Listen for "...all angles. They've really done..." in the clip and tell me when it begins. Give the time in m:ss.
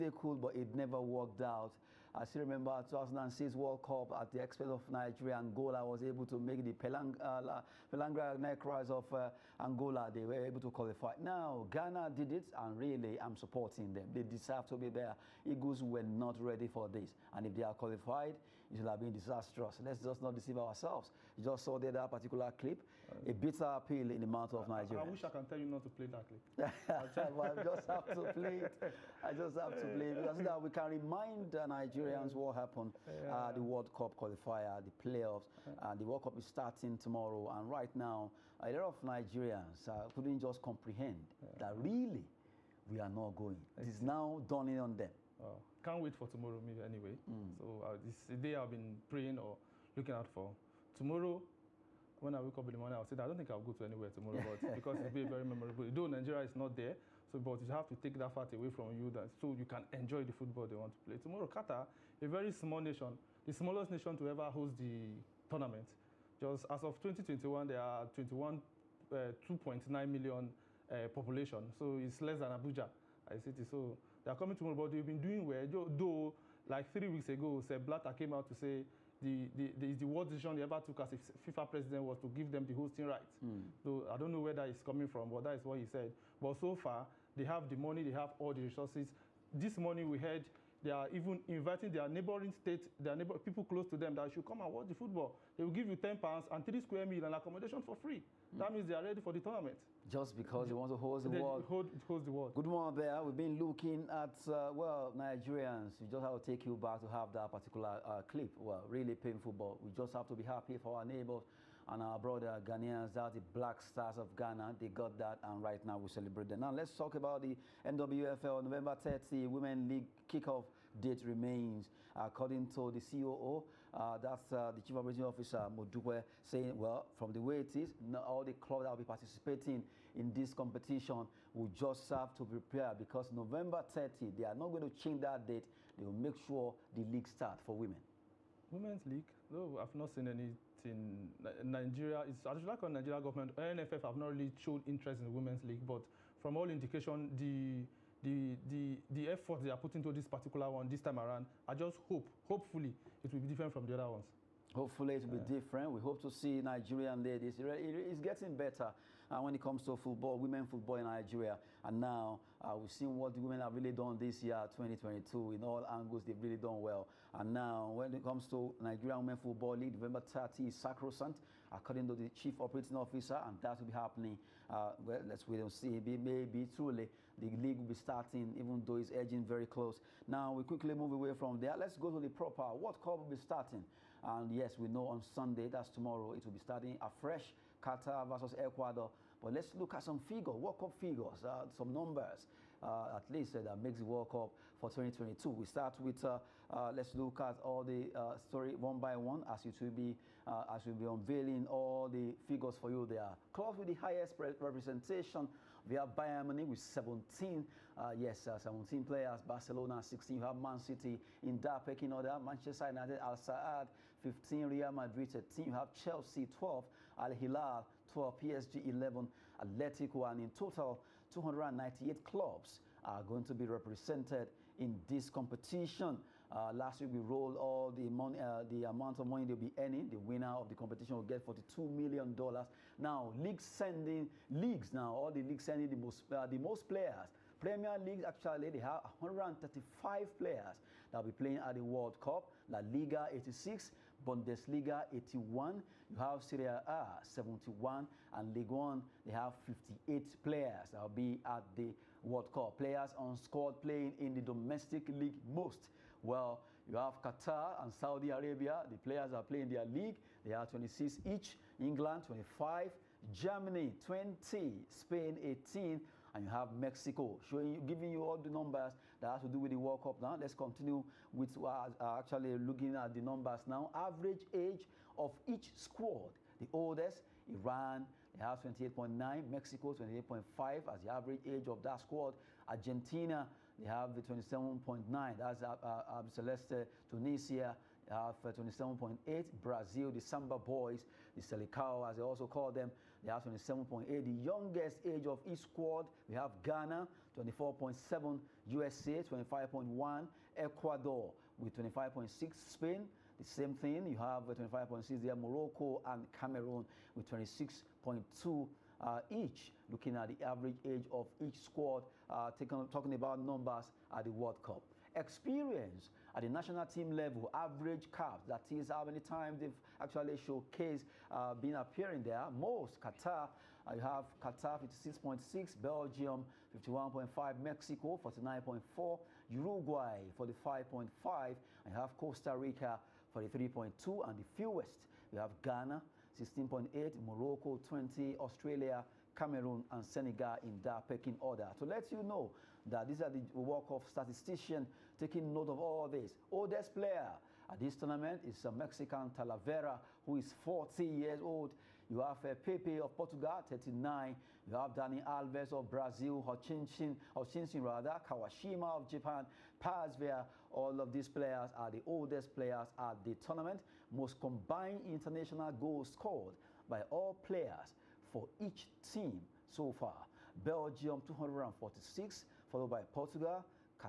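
2:45.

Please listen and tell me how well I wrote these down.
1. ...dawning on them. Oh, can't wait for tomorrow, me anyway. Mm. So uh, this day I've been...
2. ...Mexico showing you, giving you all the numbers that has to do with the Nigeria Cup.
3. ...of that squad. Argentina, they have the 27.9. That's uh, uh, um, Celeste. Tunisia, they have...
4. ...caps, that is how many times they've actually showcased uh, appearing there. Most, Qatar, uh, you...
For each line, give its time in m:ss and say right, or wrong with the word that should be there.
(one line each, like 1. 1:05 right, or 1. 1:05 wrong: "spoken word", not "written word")
1. 0:44 right
2. 4:26 wrong: "World", not "Nigeria"
3. 4:41 right
4. 5:18 right.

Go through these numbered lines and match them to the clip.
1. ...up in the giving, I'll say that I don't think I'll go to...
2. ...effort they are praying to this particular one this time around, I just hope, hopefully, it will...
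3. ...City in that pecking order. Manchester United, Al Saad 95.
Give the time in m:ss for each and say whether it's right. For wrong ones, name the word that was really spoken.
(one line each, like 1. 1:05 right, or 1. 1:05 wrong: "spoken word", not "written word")
1. 0:52 wrong: "morning", not "giving"
2. 2:29 wrong: "putting", not "praying"
3. 3:30 wrong: "15", not "95".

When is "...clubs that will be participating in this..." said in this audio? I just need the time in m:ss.
2:08.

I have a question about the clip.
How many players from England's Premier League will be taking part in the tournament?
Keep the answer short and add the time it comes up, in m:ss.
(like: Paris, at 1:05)
135, at 3:59.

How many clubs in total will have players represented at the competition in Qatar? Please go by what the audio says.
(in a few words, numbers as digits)
298.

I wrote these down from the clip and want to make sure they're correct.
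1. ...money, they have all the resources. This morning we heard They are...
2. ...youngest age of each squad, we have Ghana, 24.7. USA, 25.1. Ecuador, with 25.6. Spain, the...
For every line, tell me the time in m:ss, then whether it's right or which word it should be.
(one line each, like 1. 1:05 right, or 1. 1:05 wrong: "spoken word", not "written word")
1. 1:27 right
2. 4:54 right.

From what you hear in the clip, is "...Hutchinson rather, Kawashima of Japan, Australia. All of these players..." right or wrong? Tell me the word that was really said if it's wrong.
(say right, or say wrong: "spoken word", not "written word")
wrong: "Pazvia", not "Australia".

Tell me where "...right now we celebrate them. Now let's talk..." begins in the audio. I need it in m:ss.
1:55.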